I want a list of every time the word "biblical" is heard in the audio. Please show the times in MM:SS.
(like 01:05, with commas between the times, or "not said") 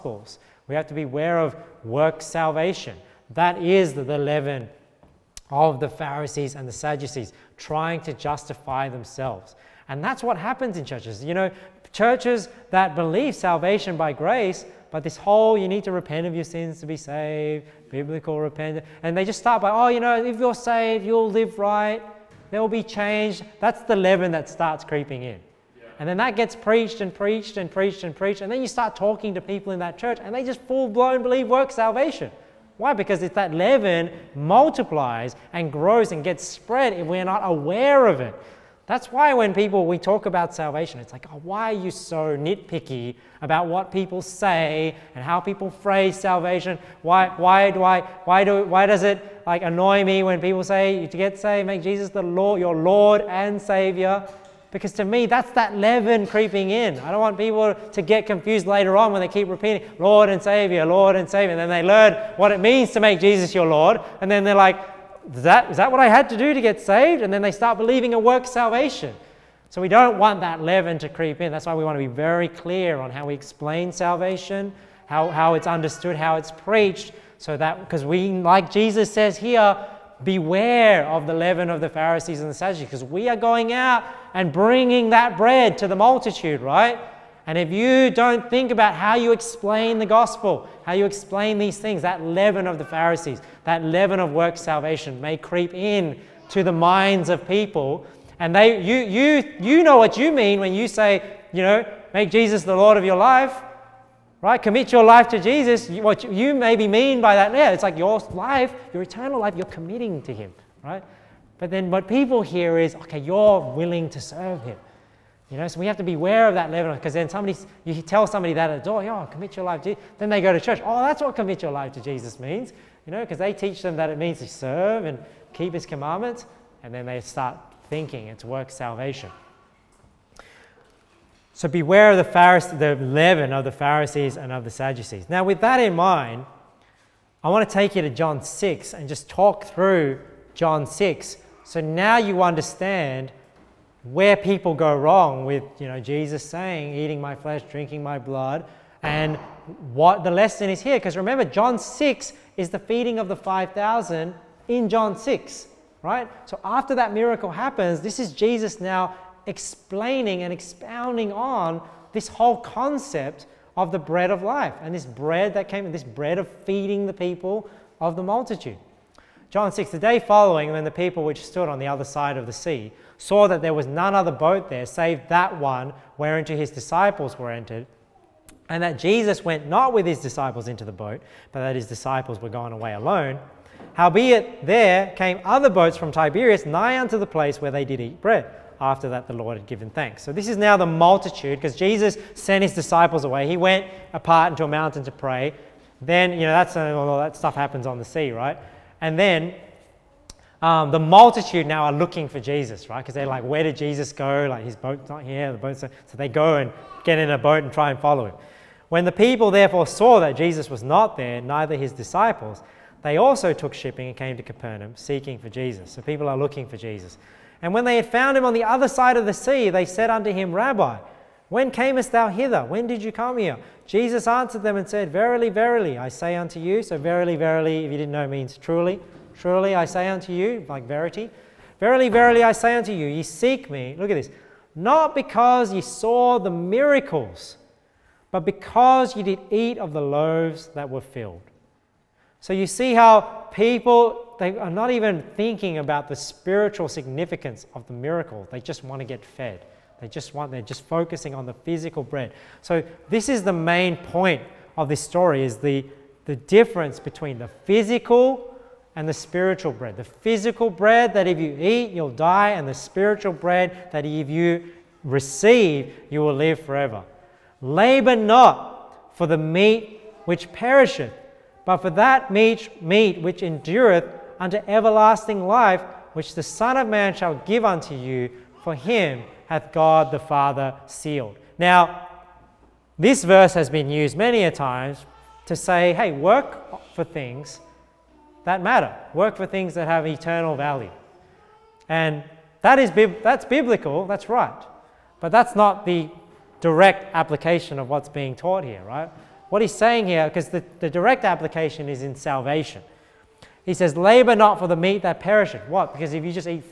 00:17, 04:53.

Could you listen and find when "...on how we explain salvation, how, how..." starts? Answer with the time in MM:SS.
01:12.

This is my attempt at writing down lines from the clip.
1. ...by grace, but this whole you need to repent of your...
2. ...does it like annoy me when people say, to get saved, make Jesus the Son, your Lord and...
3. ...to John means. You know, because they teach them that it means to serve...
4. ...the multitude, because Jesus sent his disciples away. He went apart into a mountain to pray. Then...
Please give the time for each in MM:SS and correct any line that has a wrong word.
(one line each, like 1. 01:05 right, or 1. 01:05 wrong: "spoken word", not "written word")
1. 00:13 right
2. 00:48 wrong: "Lord", not "Son"
3. 02:01 wrong: "Jesus", not "John"
4. 03:10 right.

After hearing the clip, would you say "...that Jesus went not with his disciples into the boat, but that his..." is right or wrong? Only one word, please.
right.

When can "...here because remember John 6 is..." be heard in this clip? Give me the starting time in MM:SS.
02:30.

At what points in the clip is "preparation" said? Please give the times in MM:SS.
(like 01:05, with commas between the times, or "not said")
not said.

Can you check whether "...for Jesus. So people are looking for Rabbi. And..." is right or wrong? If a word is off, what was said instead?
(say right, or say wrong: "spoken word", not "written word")
wrong: "Jesus", not "Rabbi".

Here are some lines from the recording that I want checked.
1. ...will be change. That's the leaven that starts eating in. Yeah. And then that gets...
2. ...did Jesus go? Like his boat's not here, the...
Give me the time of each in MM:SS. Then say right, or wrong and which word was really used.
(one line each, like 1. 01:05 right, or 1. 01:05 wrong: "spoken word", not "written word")
1. 00:22 wrong: "creeping", not "eating"
2. 03:23 right.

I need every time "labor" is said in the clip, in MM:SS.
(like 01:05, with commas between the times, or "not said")
04:27, 05:03.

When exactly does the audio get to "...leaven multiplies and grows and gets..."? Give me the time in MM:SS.
00:33.